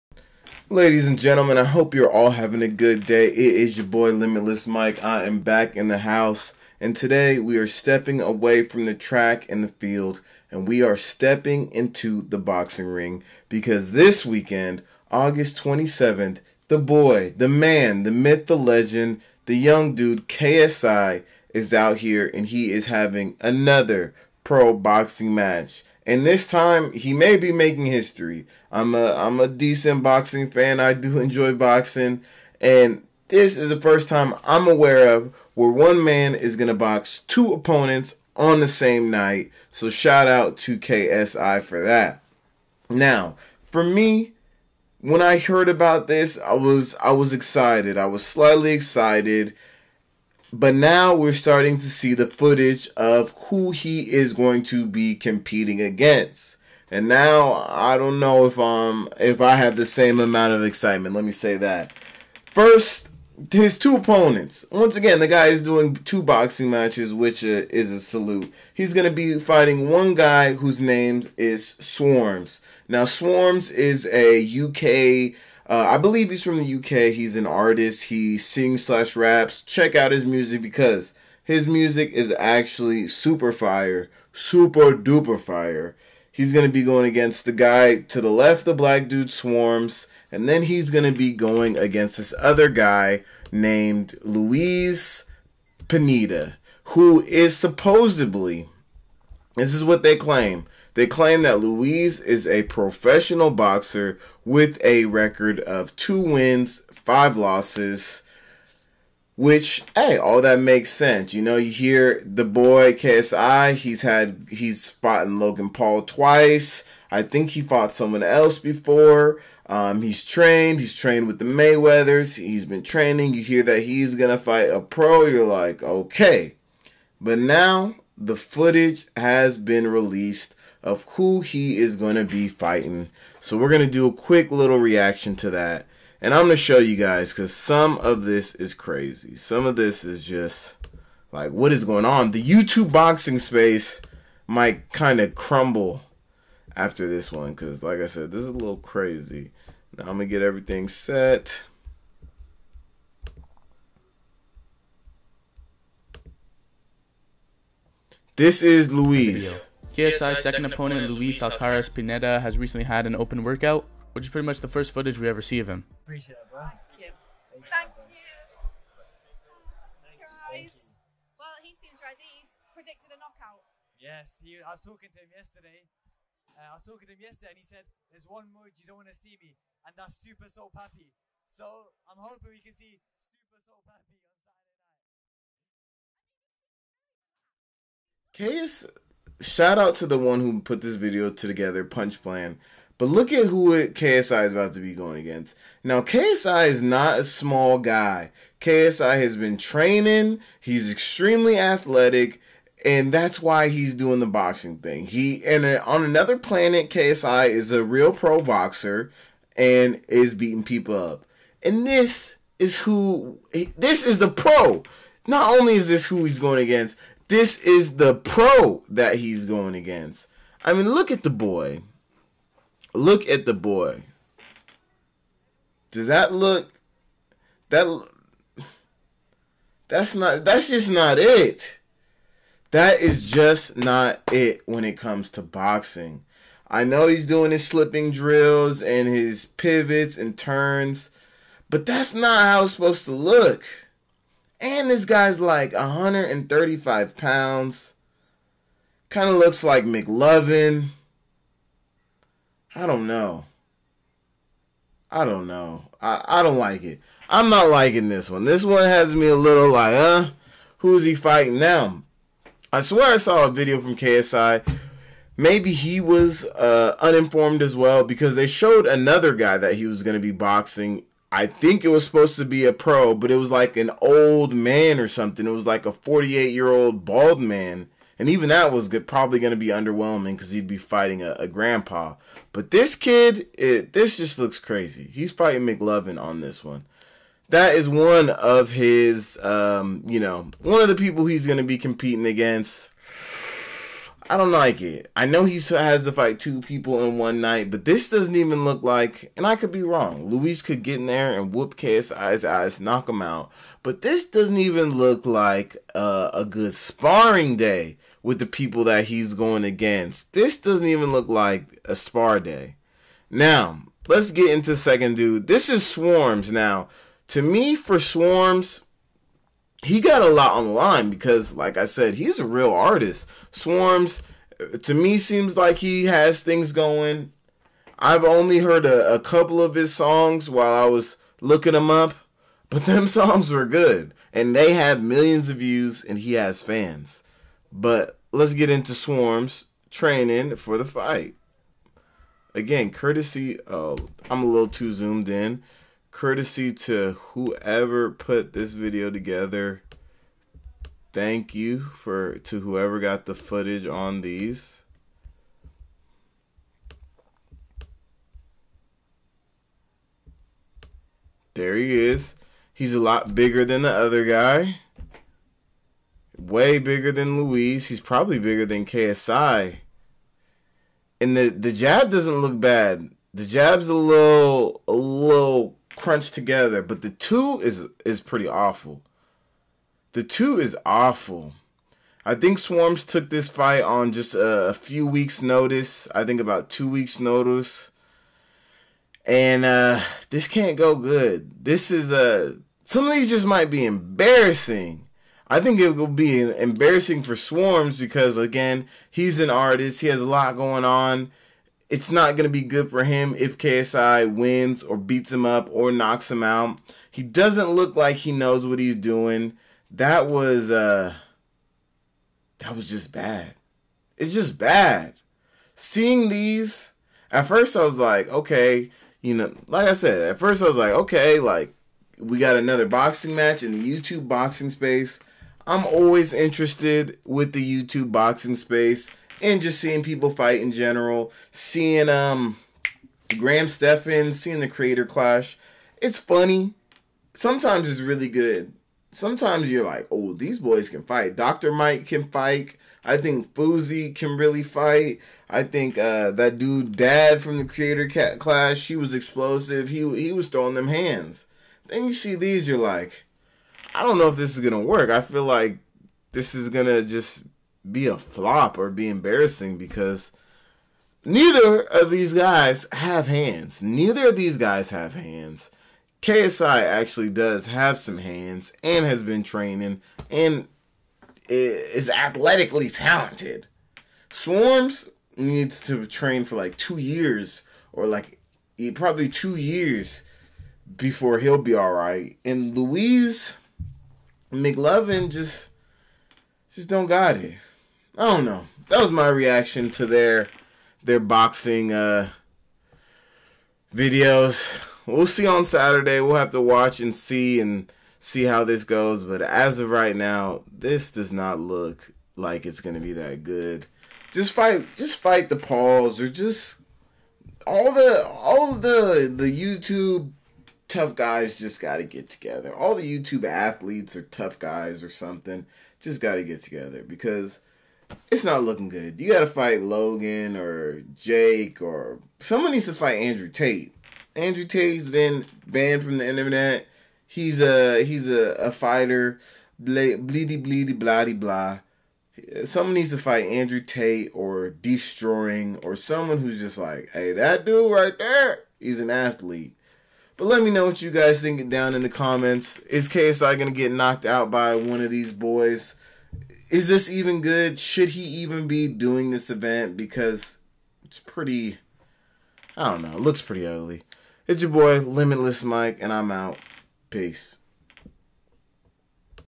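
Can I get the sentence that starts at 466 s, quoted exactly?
KSI actually does have some hands and has been training and is athletically talented.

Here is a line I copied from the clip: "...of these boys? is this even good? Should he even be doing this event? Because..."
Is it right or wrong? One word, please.
right.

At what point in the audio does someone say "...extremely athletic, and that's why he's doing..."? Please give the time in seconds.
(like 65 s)
200 s.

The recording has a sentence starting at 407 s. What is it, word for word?
He doesn't look like he knows what he's doing.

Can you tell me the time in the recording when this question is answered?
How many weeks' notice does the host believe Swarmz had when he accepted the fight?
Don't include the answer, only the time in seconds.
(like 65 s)
386 s.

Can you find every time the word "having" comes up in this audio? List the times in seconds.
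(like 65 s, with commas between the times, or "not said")
2 s, 22 s.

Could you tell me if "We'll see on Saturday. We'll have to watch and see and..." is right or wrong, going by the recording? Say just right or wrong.
right.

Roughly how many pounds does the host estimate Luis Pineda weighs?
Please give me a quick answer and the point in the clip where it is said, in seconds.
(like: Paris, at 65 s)
135, at 245 s.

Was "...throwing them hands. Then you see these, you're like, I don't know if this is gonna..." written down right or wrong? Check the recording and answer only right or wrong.
right.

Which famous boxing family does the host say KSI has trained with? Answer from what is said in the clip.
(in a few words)
The Mayweathers.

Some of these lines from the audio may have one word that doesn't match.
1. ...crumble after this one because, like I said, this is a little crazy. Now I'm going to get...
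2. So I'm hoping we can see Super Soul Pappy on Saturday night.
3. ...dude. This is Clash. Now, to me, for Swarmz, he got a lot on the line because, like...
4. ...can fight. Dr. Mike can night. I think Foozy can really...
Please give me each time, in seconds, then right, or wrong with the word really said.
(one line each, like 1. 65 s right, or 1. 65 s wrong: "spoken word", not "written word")
1. 145 s right
2. 181 s right
3. 315 s wrong: "Swarmz", not "Clash"
4. 440 s wrong: "fight", not "night".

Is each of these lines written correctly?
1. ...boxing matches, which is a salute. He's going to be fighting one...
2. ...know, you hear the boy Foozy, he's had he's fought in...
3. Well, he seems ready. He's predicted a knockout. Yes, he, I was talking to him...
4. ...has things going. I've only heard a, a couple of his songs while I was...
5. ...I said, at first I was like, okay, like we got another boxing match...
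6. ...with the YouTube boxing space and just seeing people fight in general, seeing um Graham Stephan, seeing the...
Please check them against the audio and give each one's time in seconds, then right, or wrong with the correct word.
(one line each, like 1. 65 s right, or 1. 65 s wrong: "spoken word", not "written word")
1. 66 s right
2. 111 s wrong: "KSI", not "Foozy"
3. 166 s right
4. 326 s right
5. 419 s right
6. 427 s right.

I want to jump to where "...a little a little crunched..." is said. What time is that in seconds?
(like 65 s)
373 s.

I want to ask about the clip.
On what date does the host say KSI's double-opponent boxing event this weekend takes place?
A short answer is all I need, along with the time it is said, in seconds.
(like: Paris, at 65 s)
August 27th, at 15 s.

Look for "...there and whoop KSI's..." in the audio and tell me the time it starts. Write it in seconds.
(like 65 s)
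301 s.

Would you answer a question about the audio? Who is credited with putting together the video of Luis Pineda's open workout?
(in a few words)
Punch Plan.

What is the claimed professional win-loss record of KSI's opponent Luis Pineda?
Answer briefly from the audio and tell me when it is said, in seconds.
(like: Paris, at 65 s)
2 wins, 5 losses, at 105 s.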